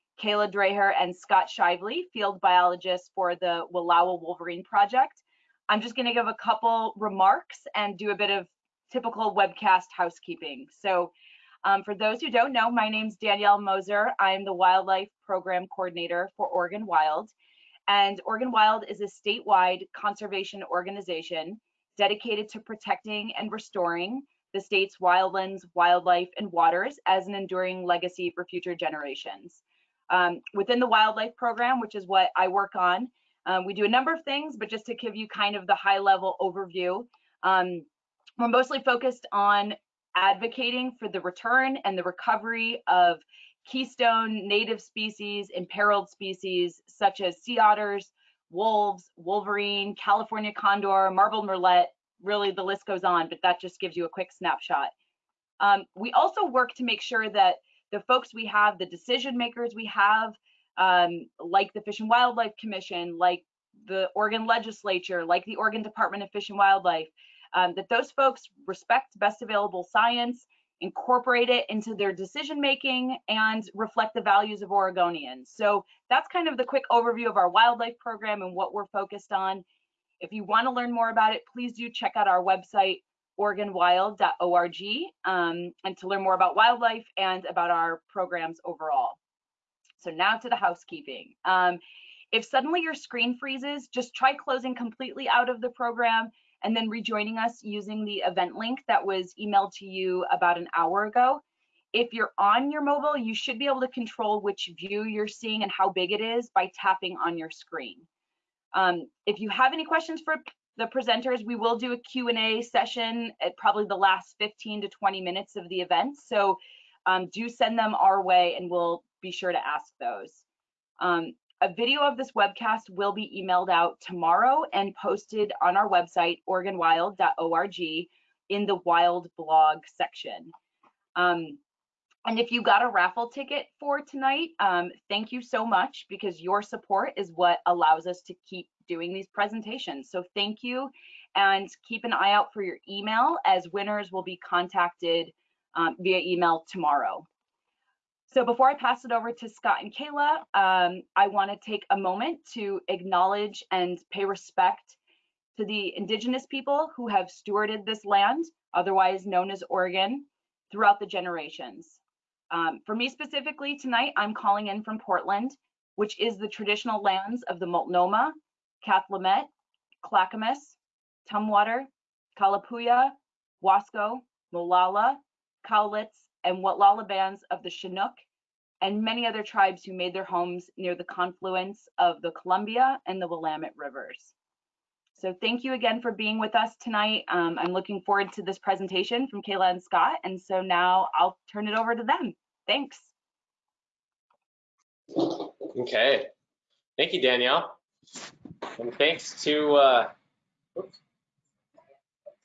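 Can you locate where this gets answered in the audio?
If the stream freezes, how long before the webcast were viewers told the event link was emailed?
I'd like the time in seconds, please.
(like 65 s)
100 s.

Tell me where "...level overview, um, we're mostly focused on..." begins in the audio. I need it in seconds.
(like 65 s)
35 s.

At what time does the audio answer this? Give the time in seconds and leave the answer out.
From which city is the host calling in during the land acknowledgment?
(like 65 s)
164 s.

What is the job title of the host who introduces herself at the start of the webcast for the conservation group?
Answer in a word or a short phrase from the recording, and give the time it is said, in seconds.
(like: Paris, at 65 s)
Wildlife Program Coordinator, at 14 s.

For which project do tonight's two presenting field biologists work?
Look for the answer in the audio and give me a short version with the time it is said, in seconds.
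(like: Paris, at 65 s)
Wallowa Wolverine Project, at 3 s.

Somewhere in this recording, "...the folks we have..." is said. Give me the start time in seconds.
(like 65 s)
57 s.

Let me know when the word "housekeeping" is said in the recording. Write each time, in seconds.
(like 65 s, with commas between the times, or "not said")
9 s, 90 s.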